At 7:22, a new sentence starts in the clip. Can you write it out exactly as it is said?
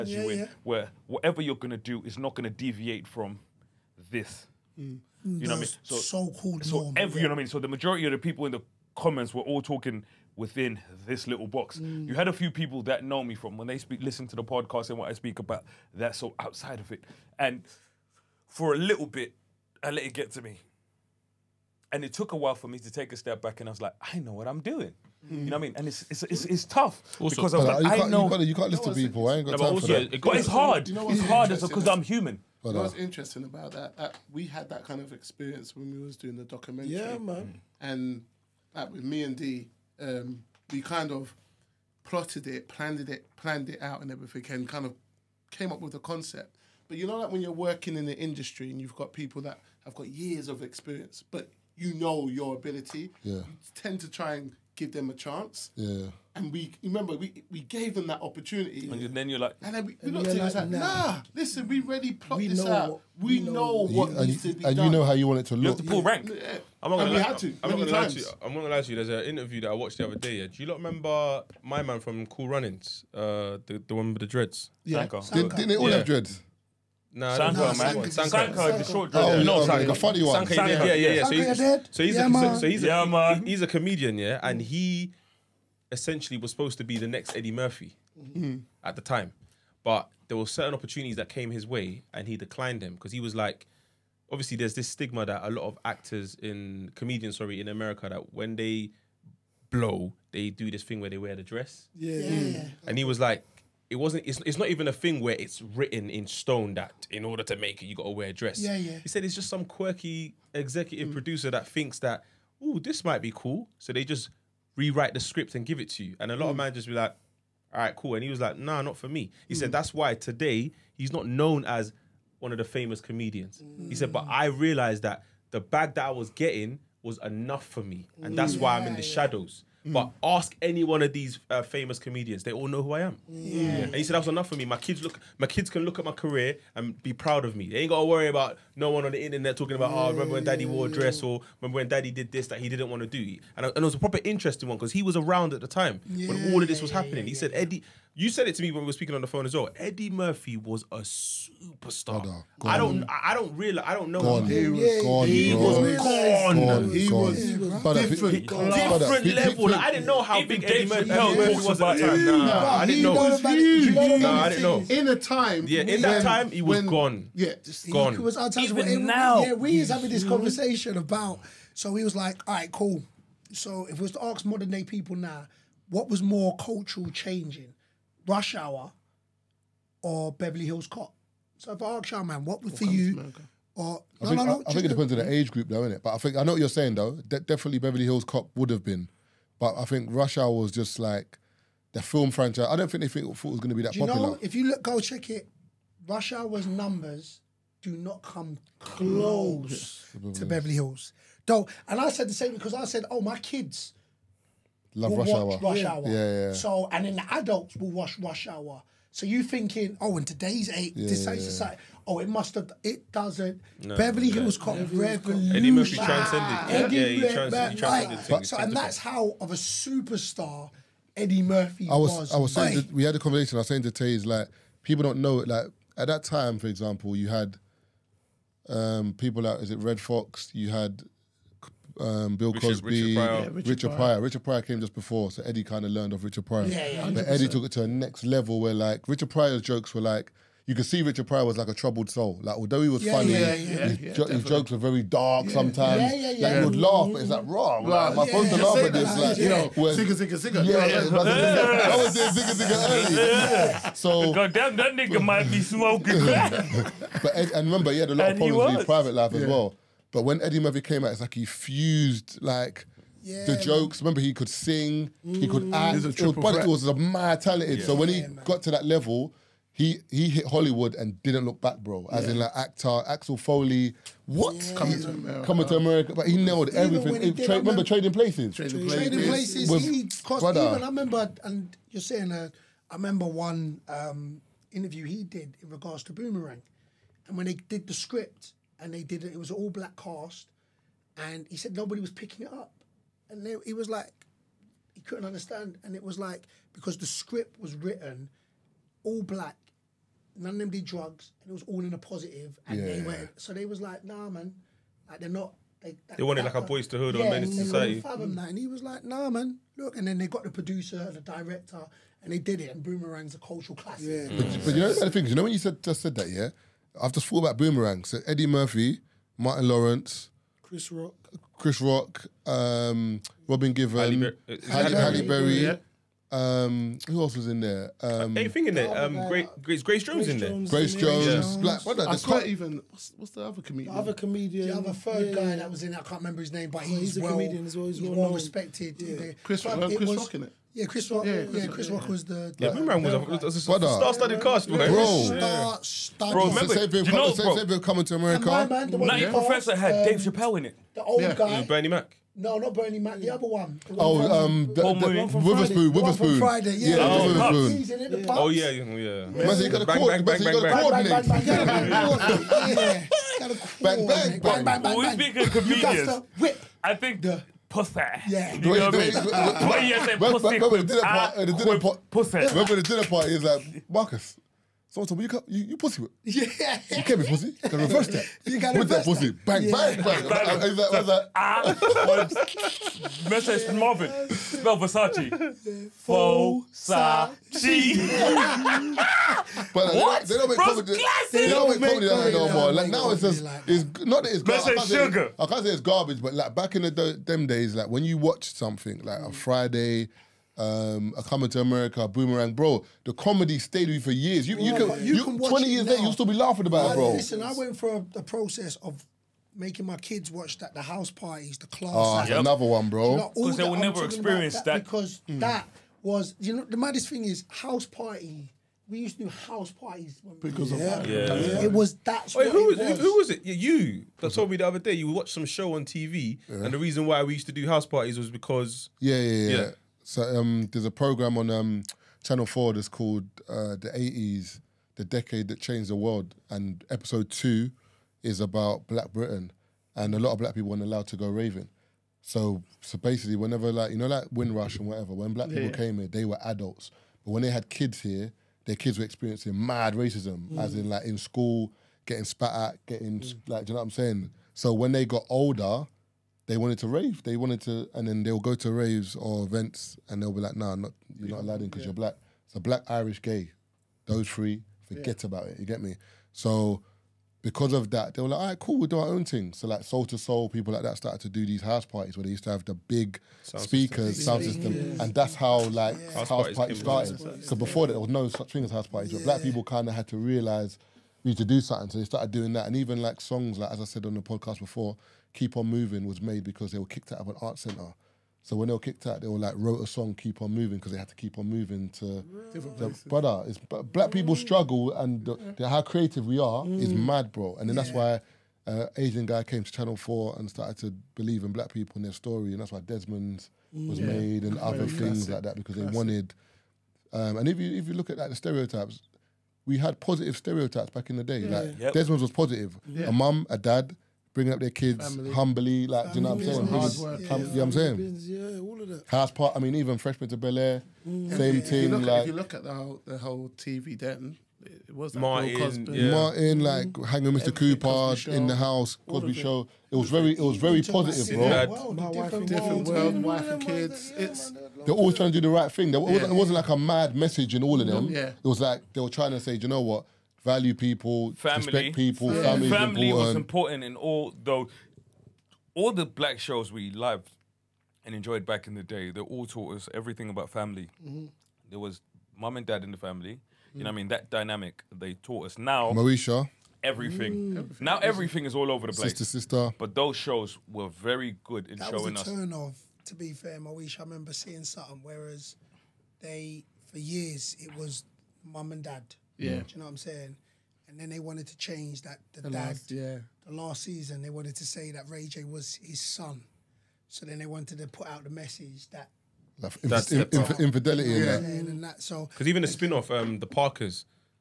So, so basically, whenever like you know, like Windrush and whatever, when Black people yeah.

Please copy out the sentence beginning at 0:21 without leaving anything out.
And it took a while for me to take a step back, and I was like, I know what I'm doing.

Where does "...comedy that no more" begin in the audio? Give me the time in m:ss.
6:31.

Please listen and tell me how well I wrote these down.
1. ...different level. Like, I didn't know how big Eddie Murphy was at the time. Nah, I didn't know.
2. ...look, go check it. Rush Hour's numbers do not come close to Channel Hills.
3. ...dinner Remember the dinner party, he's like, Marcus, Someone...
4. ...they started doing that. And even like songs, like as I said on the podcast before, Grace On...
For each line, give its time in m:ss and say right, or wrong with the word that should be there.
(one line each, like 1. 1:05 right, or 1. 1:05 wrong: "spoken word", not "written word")
1. 2:39 right
2. 3:14 wrong: "Beverly", not "Channel"
3. 6:10 right
4. 8:01 wrong: "Keep", not "Grace".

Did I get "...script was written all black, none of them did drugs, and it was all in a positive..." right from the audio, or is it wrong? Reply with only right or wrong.
right.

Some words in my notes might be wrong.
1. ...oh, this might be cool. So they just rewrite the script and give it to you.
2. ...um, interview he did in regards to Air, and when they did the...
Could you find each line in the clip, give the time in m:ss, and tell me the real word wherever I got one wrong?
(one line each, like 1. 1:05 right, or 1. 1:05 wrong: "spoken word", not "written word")
1. 1:52 right
2. 4:43 wrong: "Boomerang", not "Air".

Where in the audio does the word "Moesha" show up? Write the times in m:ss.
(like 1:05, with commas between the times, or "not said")
9:15, 9:23.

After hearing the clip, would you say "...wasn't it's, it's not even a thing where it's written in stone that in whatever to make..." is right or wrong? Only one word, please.
wrong.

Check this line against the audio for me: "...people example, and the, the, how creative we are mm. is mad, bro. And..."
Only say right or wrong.
wrong.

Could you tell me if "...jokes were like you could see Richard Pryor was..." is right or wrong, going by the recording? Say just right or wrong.
right.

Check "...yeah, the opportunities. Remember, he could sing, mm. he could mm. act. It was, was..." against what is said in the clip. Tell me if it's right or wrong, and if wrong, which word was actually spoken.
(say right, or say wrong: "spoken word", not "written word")
wrong: "jokes", not "opportunities".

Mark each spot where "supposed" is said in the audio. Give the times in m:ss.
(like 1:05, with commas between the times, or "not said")
1:26, 4:08.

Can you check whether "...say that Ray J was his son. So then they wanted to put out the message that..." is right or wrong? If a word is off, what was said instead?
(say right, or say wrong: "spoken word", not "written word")
right.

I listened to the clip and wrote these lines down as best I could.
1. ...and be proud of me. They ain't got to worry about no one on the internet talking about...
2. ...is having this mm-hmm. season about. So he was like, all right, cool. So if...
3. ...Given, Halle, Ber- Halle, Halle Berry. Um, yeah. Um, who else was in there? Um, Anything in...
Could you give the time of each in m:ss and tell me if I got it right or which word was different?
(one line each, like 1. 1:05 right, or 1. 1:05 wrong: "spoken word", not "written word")
1. 2:16 right
2. 2:49 wrong: "conversation", not "season"
3. 5:23 right.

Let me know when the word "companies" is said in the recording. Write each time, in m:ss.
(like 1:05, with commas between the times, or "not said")
not said.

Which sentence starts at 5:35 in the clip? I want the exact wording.
I can't remember his name, but oh, he's, he's well, a comedian as well.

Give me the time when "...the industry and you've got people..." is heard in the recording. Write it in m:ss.
0:48.